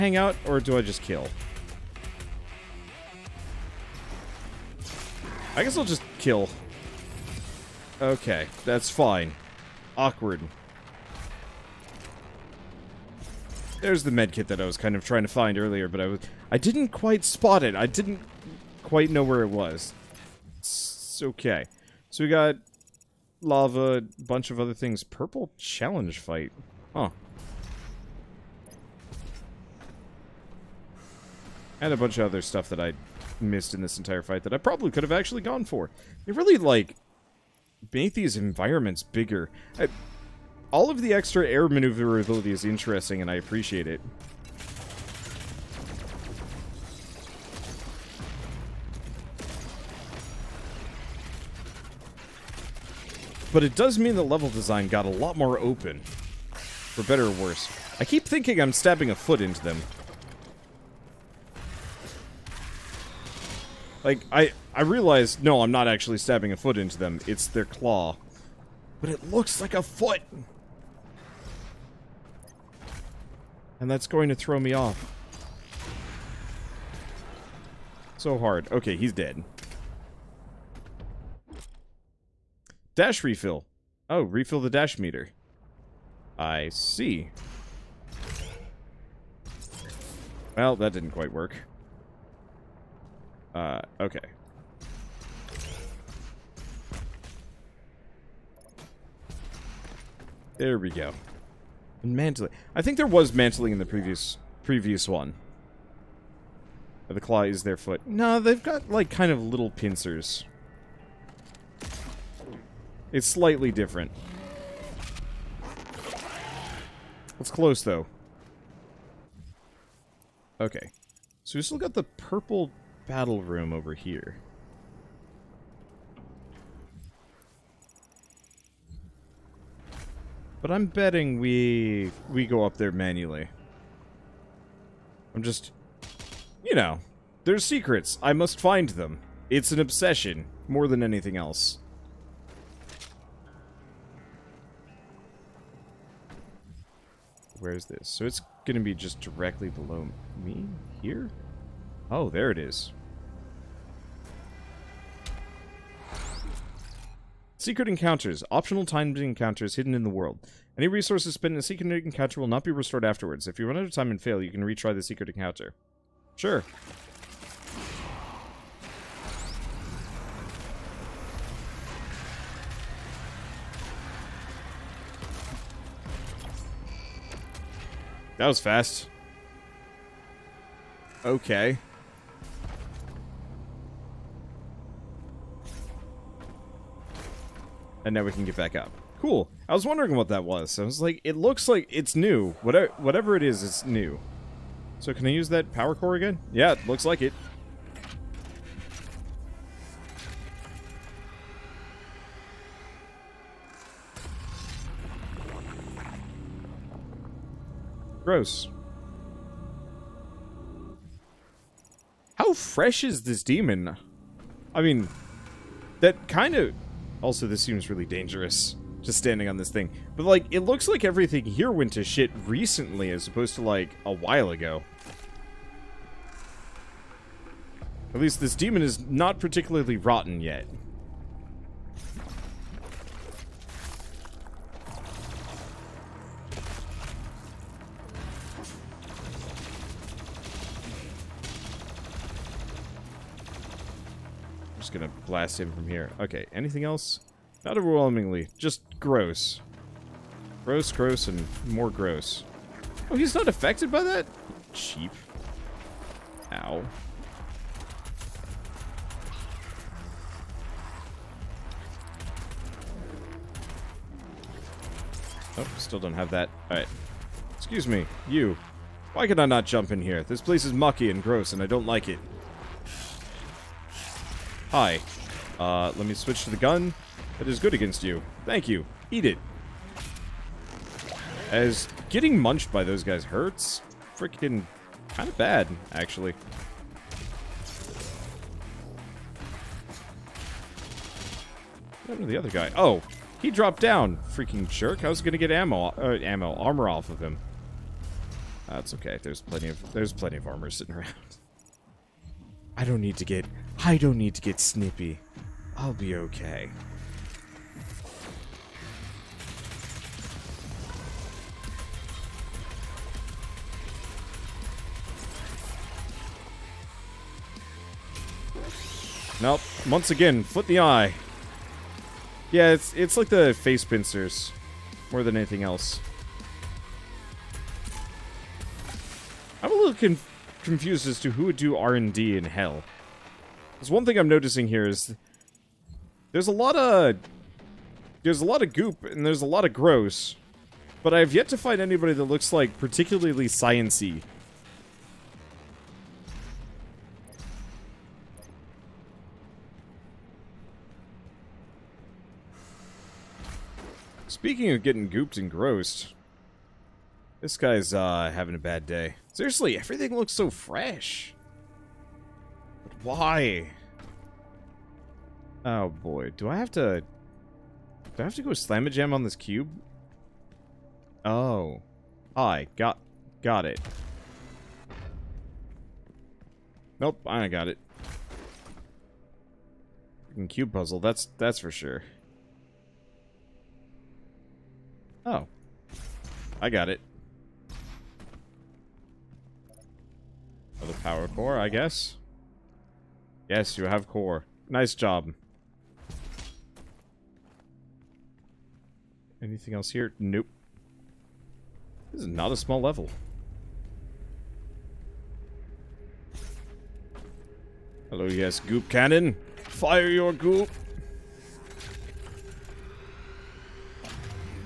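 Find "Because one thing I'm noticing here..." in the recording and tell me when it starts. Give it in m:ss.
5:33.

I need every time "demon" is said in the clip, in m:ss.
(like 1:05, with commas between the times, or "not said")
3:33, 3:48.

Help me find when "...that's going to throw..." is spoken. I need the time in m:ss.
1:13.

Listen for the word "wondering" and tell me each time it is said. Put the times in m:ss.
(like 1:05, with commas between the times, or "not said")
3:09.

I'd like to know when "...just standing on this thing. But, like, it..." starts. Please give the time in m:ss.
3:39.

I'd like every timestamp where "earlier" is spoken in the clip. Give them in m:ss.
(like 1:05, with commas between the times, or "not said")
0:15.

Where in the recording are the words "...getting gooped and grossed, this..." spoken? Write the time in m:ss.
5:54.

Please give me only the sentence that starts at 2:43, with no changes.
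If you run out of time and fail, you can retry the secret encounter.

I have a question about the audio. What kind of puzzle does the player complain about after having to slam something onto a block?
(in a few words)
Cube puzzle.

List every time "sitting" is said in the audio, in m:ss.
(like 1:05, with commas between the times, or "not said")
5:00.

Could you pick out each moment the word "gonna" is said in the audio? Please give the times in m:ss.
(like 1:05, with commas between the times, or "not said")
2:28, 4:04.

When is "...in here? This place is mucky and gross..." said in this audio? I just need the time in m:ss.
4:29.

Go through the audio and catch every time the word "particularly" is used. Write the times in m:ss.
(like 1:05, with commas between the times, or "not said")
3:49, 5:42.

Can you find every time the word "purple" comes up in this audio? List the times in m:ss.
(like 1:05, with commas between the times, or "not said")
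0:25, 2:02.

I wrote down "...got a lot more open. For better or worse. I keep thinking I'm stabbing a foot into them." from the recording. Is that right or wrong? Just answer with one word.
right.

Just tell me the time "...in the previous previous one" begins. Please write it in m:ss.
1:43.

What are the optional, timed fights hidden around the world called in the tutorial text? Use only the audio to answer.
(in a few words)
Secret encounters.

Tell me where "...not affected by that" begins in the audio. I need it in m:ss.
4:13.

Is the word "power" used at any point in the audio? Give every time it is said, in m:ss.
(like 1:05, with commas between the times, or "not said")
3:15, 6:31.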